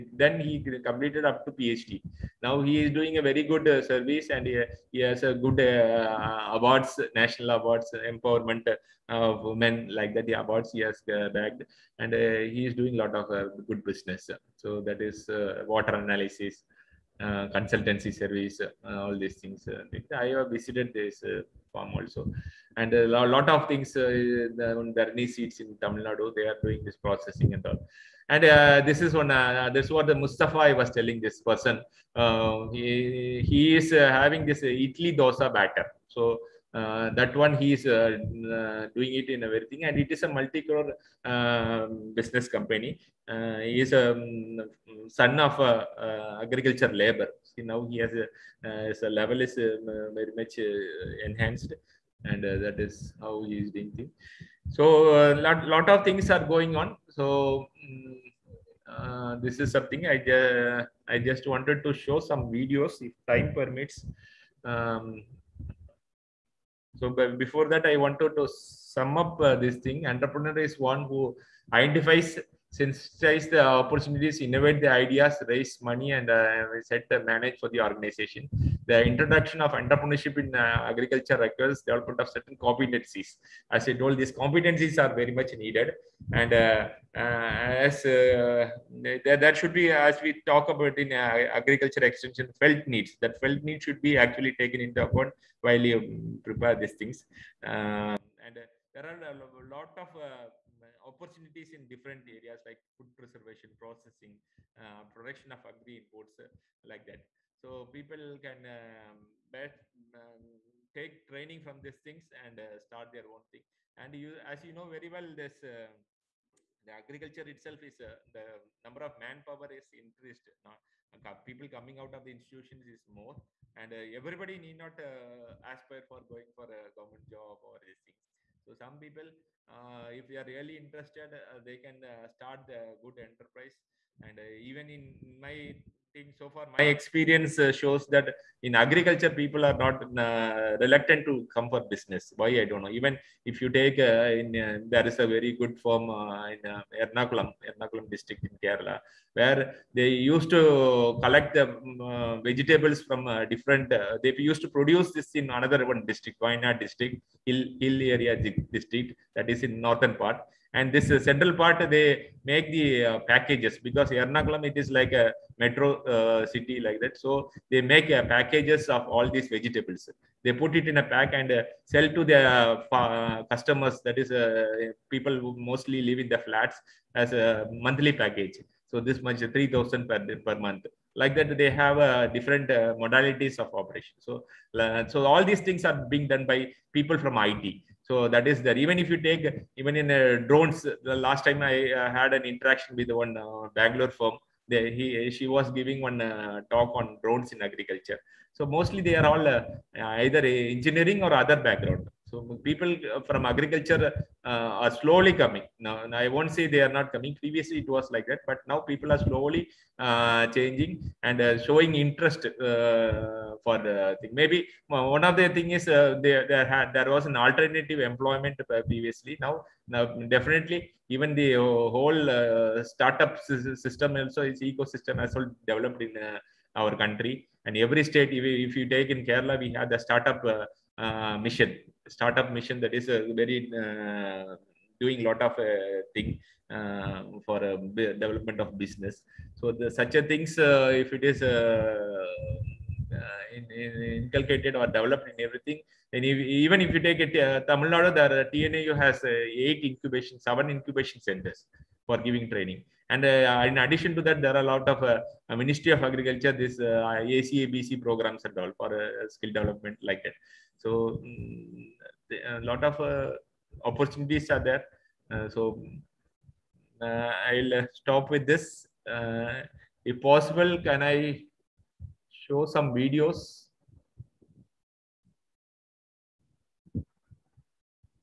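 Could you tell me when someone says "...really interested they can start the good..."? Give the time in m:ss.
2:10.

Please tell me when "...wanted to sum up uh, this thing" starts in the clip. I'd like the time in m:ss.
1:07.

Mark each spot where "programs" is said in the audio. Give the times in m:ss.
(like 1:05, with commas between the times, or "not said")
4:18.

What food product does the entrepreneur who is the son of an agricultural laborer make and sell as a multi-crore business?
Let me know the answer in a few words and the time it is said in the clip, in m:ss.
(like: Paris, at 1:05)
Idli dosa batter, at 0:34.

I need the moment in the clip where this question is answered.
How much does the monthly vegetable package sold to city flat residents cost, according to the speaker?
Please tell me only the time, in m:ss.
2:59.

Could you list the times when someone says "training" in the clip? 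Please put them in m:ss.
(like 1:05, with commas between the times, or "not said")
1:51, 4:12.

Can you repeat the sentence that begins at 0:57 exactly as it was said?
So mm, uh, this is something I, uh, I just wanted to show some videos if time permits.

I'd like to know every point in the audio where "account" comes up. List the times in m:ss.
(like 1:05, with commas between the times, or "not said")
1:35.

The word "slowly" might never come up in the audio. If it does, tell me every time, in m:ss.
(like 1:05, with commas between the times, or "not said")
3:24, 3:29.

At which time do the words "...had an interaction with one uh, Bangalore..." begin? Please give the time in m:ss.
3:12.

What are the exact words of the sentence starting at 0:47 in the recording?
See, now he has a, his level is um, very much enhanced, and that is how he is doing things.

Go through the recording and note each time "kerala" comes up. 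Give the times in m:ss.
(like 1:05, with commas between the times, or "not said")
2:28, 3:49.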